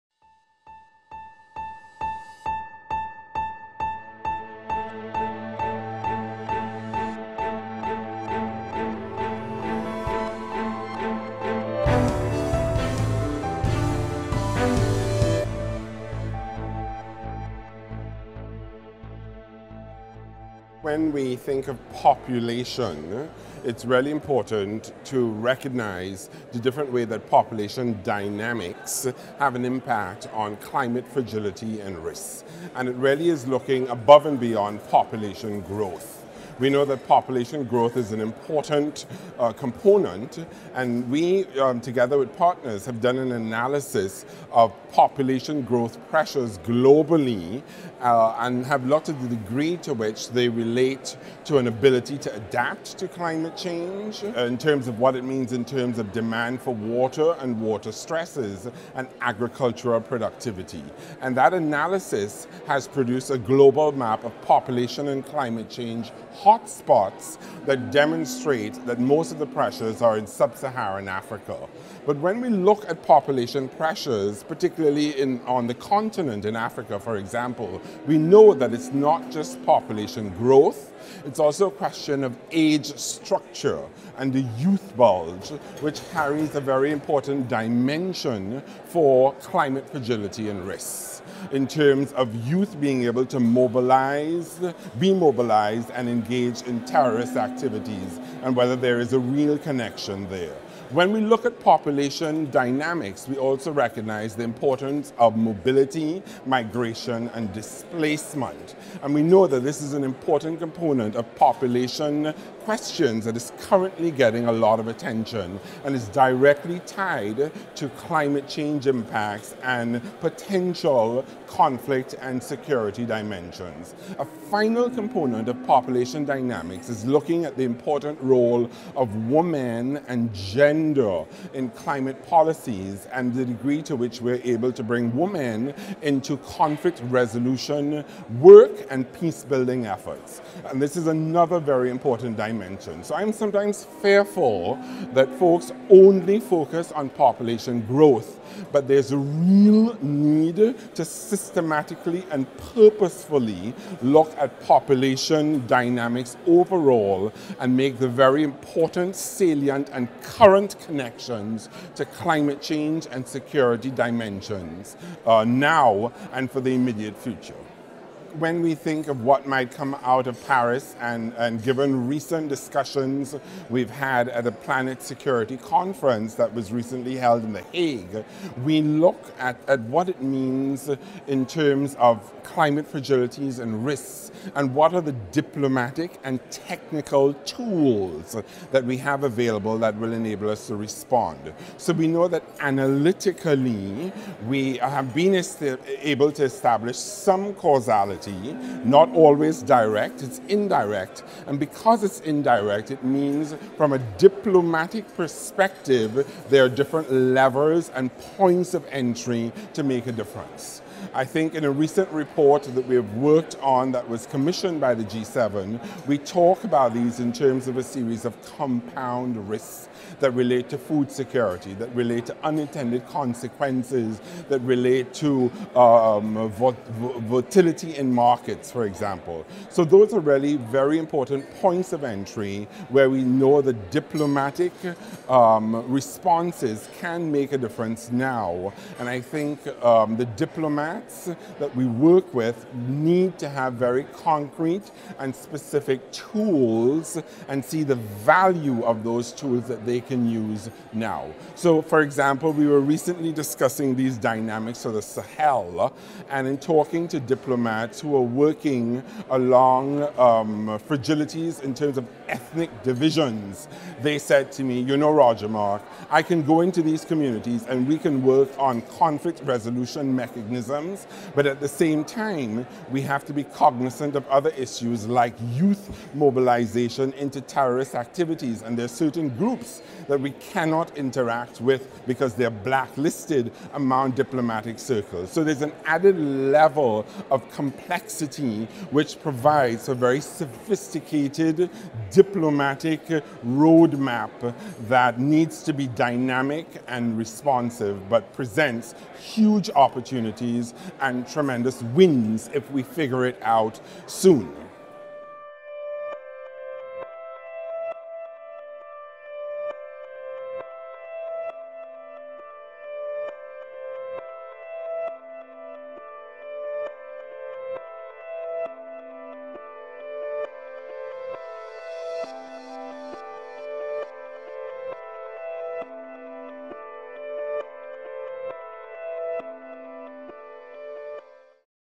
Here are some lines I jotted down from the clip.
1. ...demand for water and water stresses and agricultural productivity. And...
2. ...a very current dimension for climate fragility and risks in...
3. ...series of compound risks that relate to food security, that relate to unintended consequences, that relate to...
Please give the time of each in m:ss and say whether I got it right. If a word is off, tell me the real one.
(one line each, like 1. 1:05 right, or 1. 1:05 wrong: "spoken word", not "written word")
1. 0:56 right
2. 1:26 wrong: "important", not "current"
3. 3:37 right.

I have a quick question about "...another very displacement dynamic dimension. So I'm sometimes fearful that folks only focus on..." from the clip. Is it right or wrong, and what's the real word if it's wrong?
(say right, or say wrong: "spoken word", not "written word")
wrong: "important", not "displacement".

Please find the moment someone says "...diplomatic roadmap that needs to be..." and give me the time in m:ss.
4:52.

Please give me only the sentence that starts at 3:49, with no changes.
So those are really very important points of entry where we know the diplomatic um, responses can make a difference now.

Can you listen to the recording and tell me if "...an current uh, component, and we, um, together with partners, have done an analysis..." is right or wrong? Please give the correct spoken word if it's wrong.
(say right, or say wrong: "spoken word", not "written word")
wrong: "important", not "current".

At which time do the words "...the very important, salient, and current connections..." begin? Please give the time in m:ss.
2:38.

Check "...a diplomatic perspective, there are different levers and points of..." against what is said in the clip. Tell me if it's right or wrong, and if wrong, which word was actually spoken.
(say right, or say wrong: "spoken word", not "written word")
right.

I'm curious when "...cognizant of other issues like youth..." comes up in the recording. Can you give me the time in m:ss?
4:33.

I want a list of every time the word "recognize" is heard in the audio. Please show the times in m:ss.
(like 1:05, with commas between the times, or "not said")
0:25, 1:43.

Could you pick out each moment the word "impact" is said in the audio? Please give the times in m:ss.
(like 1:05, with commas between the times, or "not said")
0:29, 1:58.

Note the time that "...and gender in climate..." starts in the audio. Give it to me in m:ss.
2:10.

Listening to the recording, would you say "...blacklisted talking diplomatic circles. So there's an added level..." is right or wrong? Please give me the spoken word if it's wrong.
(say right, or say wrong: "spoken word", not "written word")
wrong: "among", not "talking".